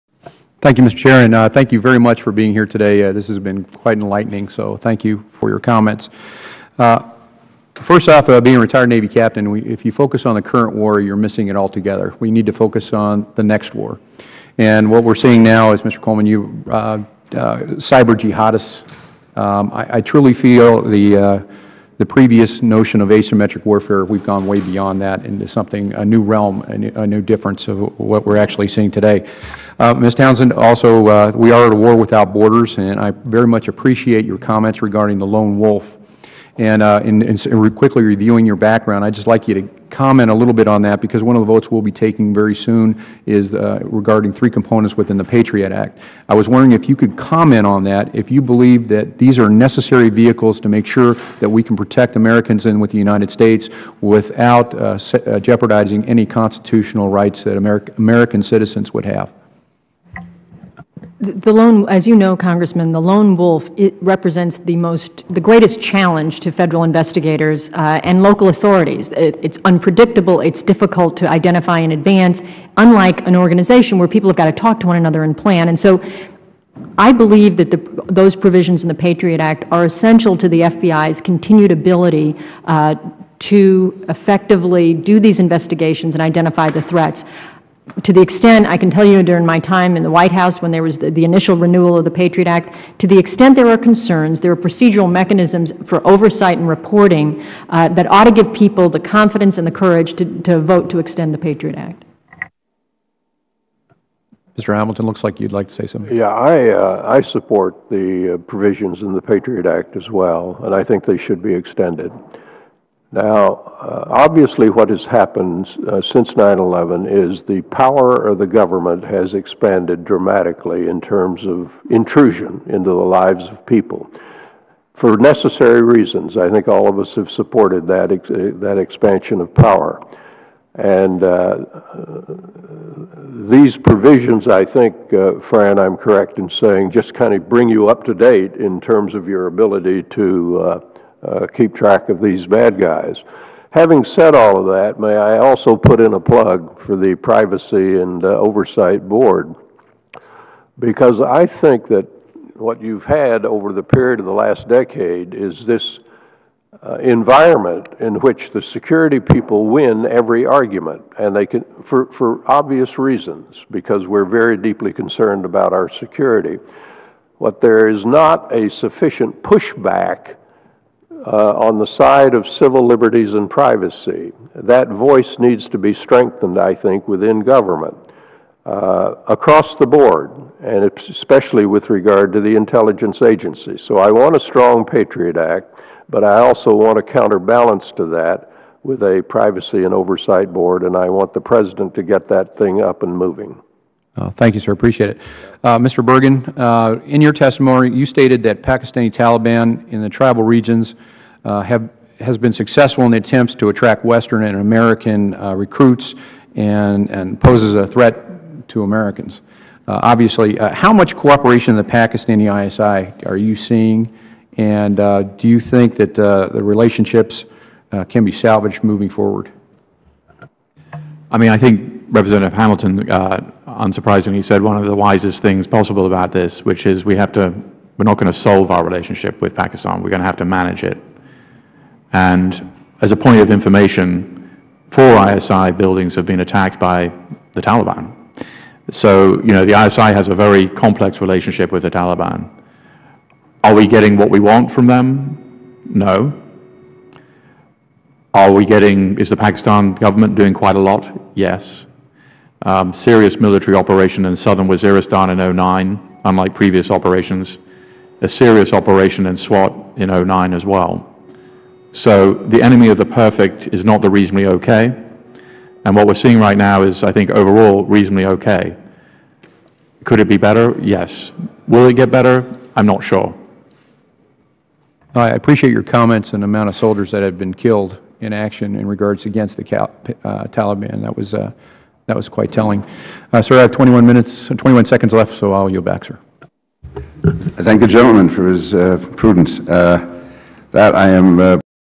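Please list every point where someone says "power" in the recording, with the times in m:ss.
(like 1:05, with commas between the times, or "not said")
1:57, 2:09.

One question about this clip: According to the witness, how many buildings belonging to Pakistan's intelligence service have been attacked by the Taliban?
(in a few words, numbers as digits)
4.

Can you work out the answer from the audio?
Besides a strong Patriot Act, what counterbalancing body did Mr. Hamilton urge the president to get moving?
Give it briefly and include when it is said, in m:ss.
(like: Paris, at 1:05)
Privacy and Oversight Board, at 2:27.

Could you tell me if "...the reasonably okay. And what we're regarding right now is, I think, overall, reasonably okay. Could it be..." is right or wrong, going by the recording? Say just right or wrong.
wrong.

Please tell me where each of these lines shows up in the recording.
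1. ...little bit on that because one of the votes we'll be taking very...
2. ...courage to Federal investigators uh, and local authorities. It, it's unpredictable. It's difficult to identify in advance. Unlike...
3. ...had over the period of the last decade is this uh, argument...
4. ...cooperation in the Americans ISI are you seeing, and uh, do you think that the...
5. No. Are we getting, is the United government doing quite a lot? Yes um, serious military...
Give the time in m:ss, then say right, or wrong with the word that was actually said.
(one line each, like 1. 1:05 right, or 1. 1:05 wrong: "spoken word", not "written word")
1. 0:40 right
2. 1:05 wrong: "challenge", not "courage"
3. 2:33 wrong: "environment", not "argument"
4. 3:31 wrong: "Pakistani", not "Americans"
5. 4:05 wrong: "Pakistan", not "United".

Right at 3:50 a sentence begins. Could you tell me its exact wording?
We're going to have to manage it.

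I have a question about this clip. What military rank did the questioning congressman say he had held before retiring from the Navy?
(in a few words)
Captain.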